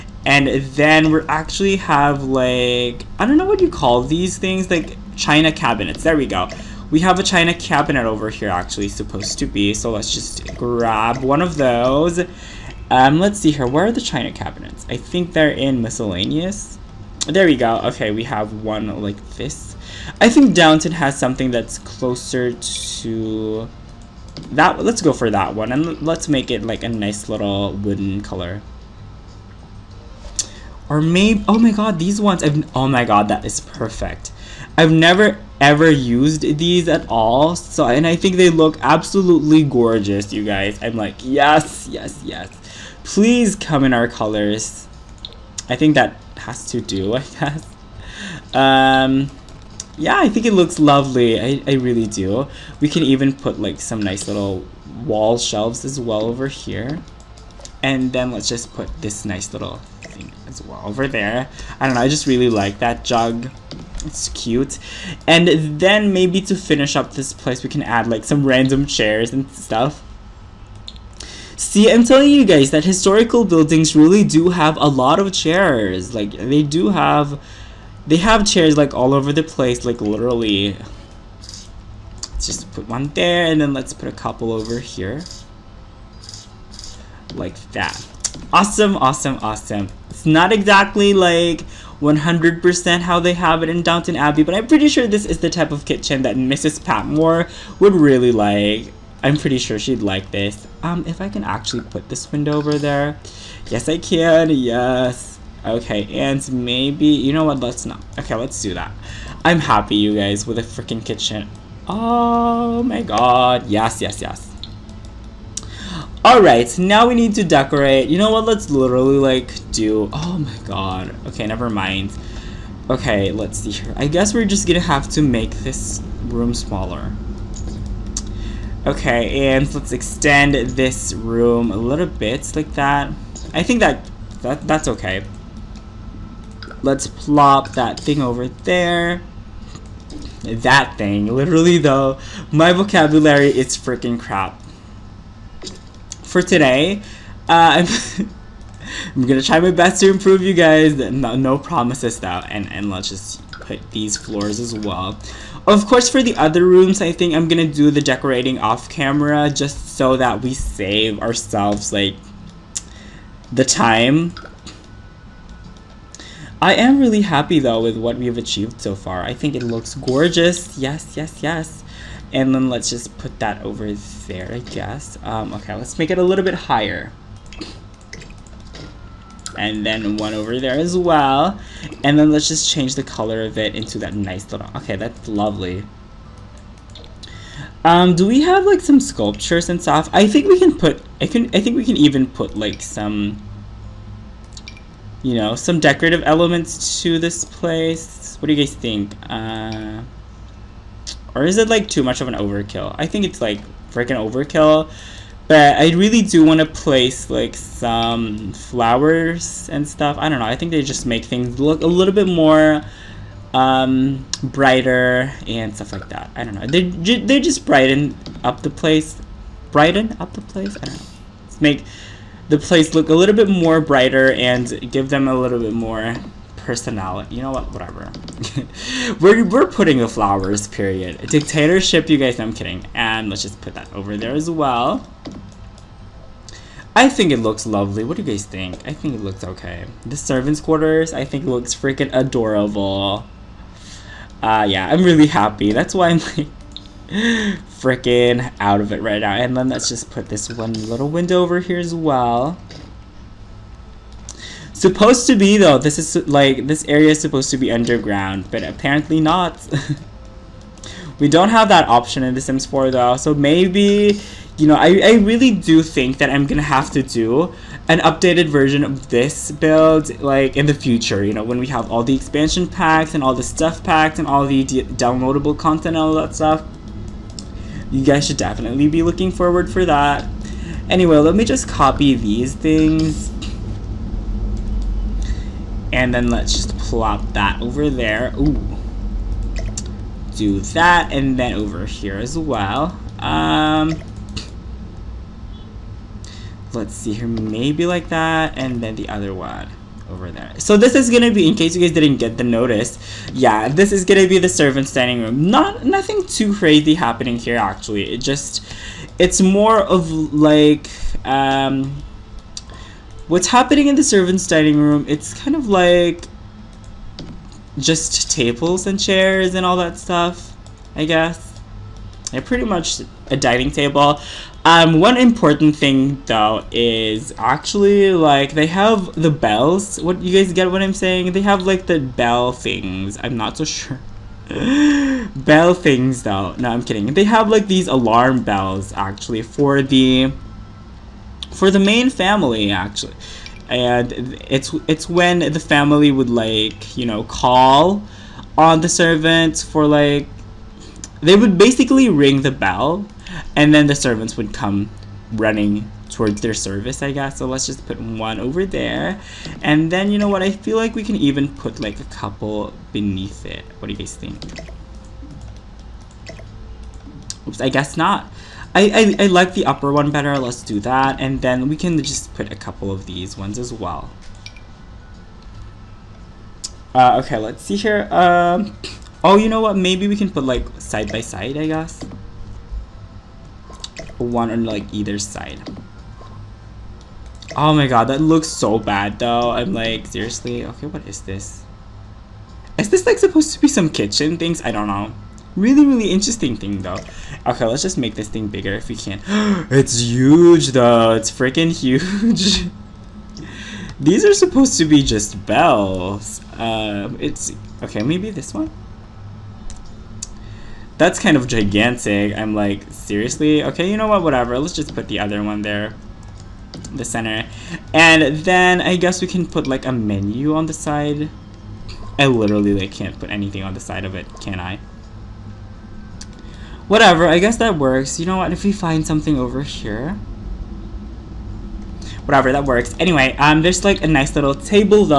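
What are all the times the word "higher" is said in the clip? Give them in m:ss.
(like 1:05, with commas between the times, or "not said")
2:56.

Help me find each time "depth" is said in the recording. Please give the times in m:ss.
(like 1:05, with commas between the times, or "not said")
not said.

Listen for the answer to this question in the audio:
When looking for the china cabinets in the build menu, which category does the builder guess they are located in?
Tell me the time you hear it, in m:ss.
0:15.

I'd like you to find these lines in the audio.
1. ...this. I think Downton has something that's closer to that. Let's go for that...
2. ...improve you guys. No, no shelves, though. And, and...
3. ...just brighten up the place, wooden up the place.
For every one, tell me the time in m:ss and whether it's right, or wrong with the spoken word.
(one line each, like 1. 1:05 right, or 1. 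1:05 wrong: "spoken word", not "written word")
1. 0:19 right
2. 2:30 wrong: "promises", not "shelves"
3. 3:37 wrong: "brighten", not "wooden".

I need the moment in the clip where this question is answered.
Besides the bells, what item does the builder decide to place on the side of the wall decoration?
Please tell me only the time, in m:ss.
6:59.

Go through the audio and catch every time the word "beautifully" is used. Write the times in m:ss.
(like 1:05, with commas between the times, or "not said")
not said.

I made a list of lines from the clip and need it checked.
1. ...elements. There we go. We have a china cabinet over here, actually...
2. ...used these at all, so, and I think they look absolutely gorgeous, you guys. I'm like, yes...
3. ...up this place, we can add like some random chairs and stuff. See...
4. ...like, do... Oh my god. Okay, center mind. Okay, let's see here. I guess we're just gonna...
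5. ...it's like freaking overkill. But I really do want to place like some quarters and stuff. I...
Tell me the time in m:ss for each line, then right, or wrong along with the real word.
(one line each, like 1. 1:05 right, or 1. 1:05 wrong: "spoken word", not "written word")
1. 0:05 wrong: "cabinets", not "elements"
2. 0:35 right
3. 1:06 right
4. 1:59 wrong: "never", not "center"
5. 3:23 wrong: "flowers", not "quarters".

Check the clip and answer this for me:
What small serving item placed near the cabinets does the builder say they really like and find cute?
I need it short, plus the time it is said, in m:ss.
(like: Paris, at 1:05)
Jug, at 1:03.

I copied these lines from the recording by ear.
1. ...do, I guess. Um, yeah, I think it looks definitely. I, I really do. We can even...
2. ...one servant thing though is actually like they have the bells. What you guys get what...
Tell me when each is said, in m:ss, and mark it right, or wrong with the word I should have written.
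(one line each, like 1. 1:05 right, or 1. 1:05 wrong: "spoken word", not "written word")
1. 0:46 wrong: "lovely", not "definitely"
2. 5:25 wrong: "important", not "servant".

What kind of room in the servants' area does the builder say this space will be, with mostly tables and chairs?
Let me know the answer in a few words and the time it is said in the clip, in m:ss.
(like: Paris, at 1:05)
Servants' dining room, at 5:14.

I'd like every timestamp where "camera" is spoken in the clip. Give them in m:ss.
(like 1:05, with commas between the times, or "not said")
2:38.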